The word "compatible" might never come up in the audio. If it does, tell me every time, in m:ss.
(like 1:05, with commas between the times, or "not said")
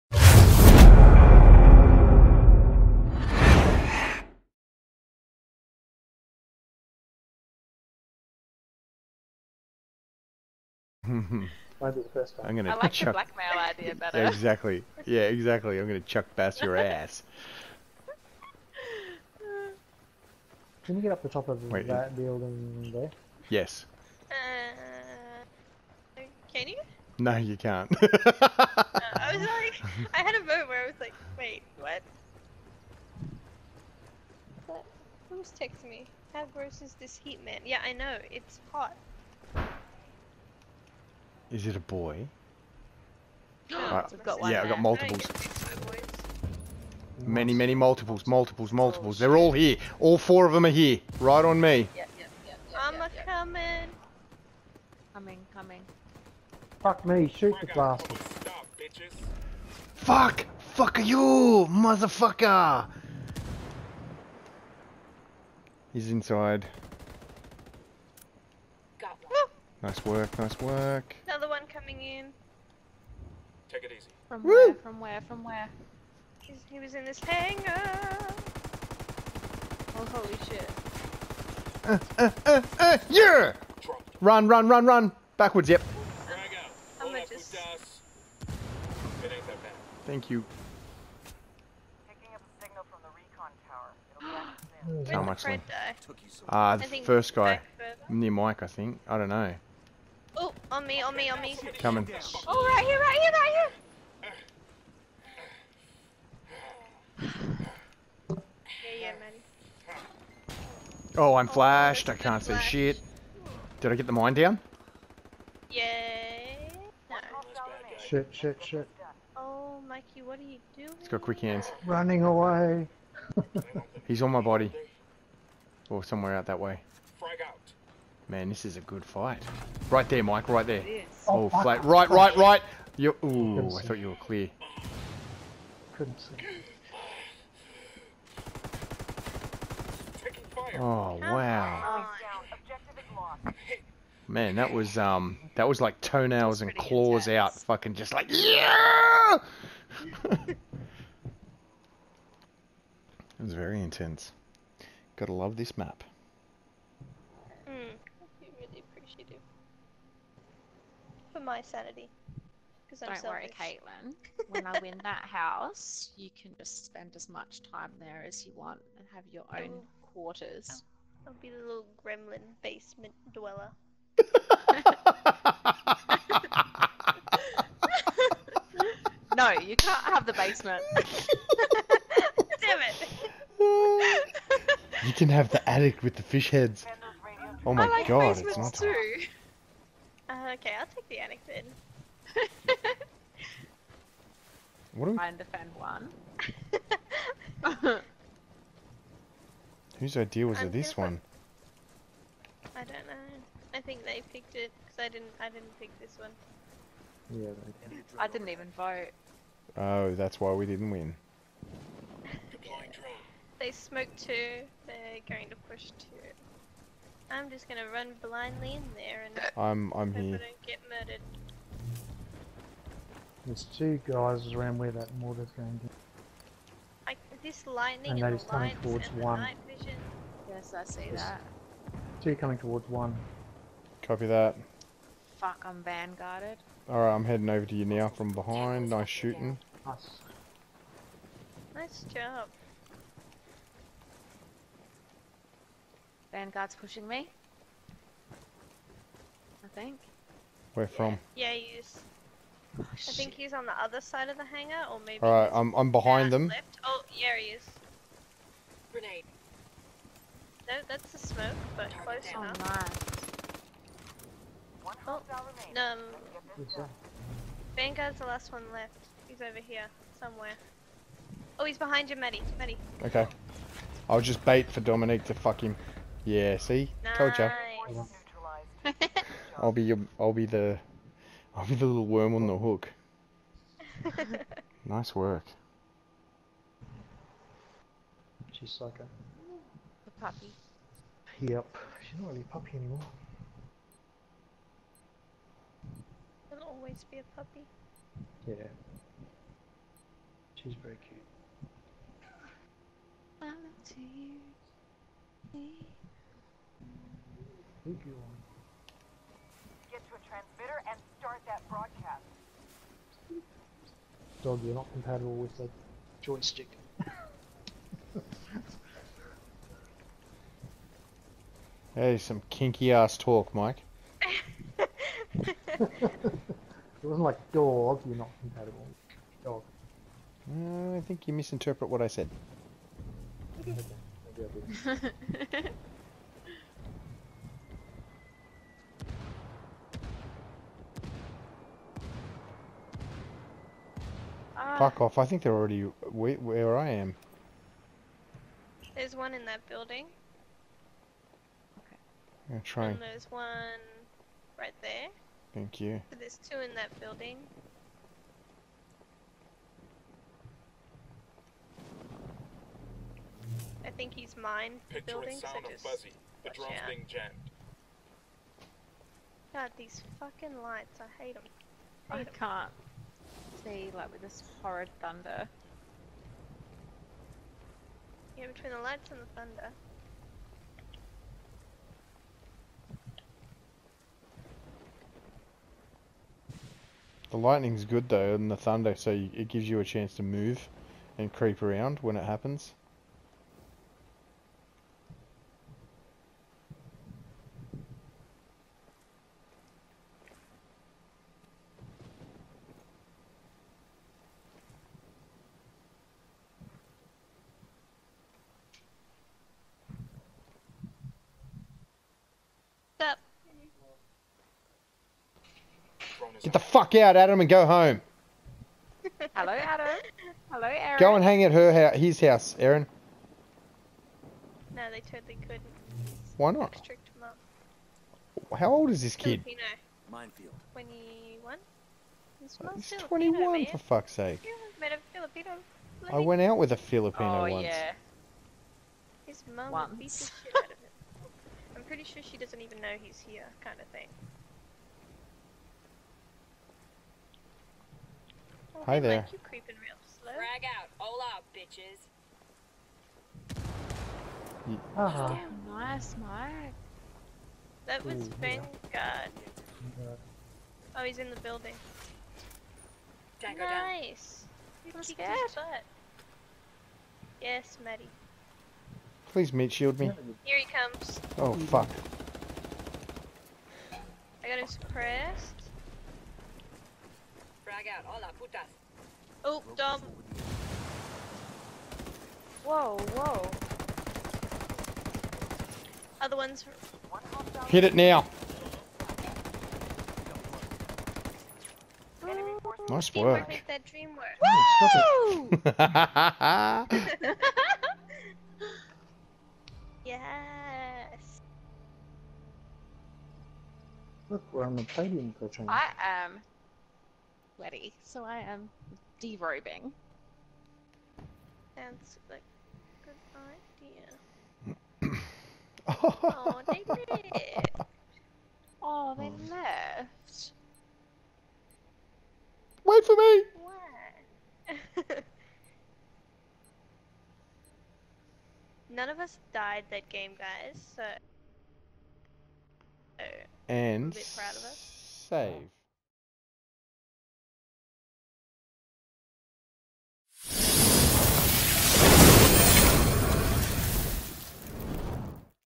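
5:14, 5:28.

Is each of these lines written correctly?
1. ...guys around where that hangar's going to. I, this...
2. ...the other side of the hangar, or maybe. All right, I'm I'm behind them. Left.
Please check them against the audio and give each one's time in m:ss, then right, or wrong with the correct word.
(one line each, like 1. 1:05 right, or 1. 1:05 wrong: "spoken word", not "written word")
1. 3:44 wrong: "mortar", not "hangar"
2. 4:13 right.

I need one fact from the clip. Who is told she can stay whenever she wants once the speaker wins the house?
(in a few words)
Caitlin.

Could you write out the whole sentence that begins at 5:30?
Uh, I think you misinterpret what I said.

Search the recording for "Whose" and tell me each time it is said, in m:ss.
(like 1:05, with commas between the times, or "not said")
3:19.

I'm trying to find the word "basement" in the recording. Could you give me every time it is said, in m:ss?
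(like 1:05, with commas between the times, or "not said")
2:52, 3:00.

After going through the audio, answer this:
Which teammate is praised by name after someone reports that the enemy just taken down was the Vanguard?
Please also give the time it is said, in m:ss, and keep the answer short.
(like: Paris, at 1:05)
Mark, at 7:36.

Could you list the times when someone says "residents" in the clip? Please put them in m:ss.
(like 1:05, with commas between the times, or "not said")
not said.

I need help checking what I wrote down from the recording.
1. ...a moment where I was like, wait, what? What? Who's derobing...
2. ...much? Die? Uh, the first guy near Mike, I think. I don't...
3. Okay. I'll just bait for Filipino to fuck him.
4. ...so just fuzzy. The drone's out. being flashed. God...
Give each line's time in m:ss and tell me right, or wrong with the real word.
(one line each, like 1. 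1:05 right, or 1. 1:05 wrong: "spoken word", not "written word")
1. 0:30 wrong: "texting", not "derobing"
2. 1:35 right
3. 4:33 wrong: "Dominique", not "Filipino"
4. 6:05 wrong: "jammed", not "flashed".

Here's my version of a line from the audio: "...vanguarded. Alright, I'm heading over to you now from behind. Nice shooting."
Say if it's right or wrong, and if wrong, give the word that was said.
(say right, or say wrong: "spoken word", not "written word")
right.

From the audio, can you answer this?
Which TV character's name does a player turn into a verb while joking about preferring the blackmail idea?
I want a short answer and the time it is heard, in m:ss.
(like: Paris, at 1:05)
Chuck Bass, at 0:15.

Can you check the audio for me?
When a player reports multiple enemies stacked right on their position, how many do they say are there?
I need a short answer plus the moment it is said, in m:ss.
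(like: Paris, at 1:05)
4, at 0:50.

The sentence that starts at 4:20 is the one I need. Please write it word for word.
No, that's the smoke, but close enough.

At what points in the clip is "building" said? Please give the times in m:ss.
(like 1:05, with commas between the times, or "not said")
0:22, 5:49, 5:56, 6:05, 7:41.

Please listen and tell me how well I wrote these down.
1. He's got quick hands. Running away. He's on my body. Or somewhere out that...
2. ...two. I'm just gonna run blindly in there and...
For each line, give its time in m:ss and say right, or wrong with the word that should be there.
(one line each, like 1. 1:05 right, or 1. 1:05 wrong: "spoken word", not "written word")
1. 2:00 right
2. 3:35 right.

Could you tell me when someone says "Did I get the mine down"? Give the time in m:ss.
1:53.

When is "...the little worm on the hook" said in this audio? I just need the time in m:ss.
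4:41.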